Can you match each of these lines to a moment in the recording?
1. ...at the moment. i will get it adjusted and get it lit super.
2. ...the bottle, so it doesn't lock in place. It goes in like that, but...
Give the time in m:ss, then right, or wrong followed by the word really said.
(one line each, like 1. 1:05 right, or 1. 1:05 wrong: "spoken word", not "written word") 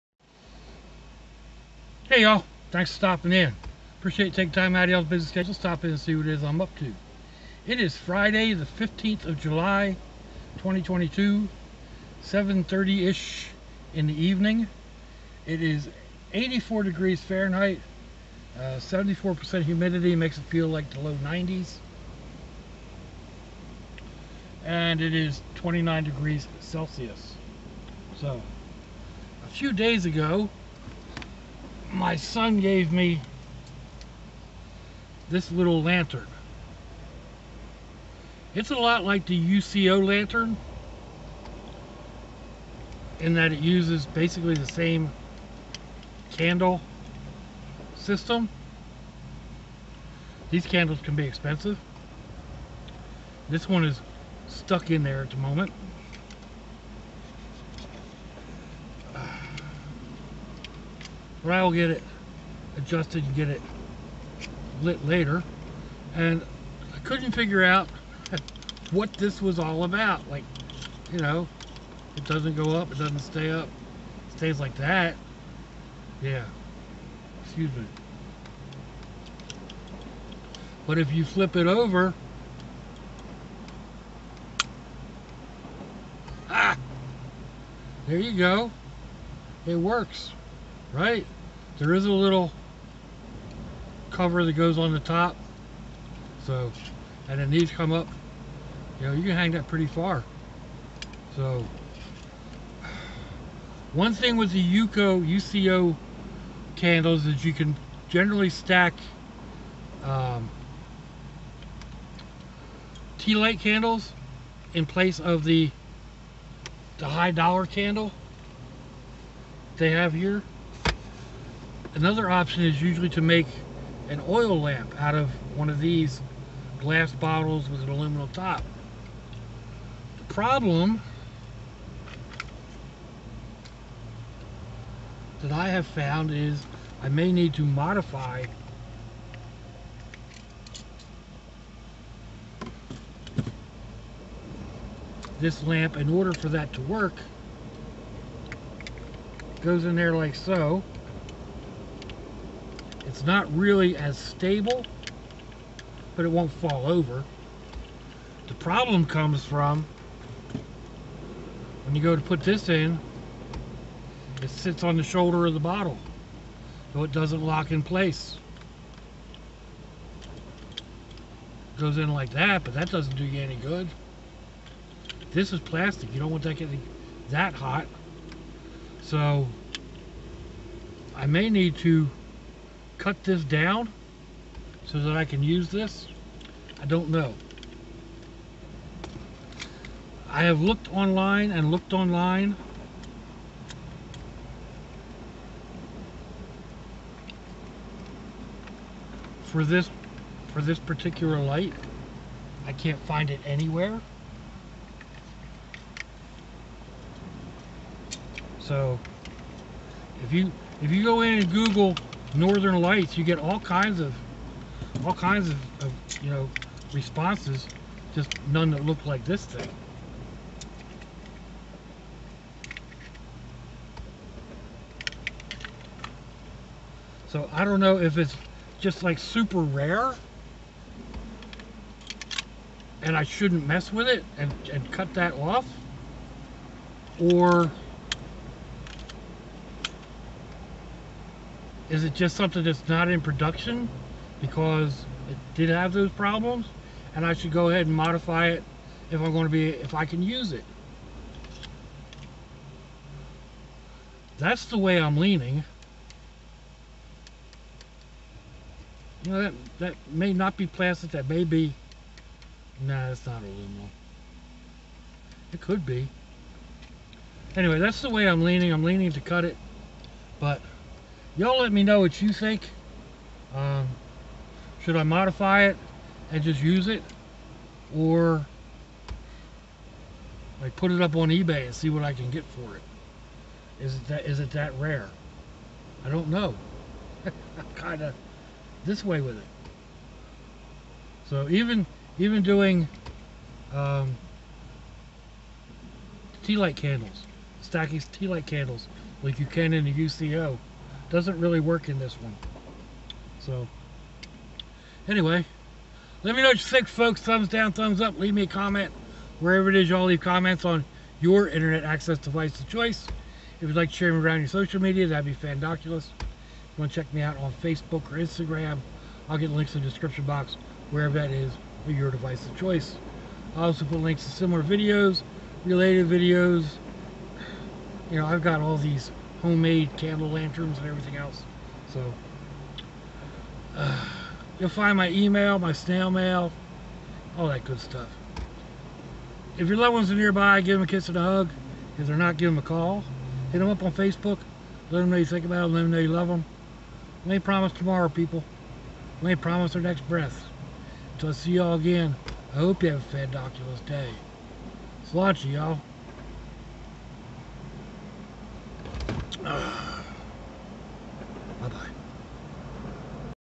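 1. 0:55 wrong: "later", not "super"
2. 2:45 right.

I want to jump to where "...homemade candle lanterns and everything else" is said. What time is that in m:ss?
5:29.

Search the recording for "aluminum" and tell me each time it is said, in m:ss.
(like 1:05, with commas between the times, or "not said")
2:07, 4:23.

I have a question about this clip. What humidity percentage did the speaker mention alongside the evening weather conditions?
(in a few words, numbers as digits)
74%.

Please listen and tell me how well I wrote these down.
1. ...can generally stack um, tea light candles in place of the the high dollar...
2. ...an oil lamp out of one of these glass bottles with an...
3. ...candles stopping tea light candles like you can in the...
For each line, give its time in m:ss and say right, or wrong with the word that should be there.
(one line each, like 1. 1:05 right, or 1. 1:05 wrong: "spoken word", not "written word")
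1. 1:47 right
2. 2:04 right
3. 4:56 wrong: "stacking", not "stopping".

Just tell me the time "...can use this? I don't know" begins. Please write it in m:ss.
3:05.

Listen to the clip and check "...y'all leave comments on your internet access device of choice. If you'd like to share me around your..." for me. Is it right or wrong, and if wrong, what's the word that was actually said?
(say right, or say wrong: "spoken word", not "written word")
right.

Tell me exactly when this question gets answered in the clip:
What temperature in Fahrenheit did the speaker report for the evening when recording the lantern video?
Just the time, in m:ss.
0:16.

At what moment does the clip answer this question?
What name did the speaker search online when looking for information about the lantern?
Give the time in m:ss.
3:32.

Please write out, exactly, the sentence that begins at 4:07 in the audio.
And I should go ahead and modify it if I'm going to be, if I can use it.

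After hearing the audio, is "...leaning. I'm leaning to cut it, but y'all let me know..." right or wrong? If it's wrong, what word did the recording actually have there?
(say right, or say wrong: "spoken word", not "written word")
right.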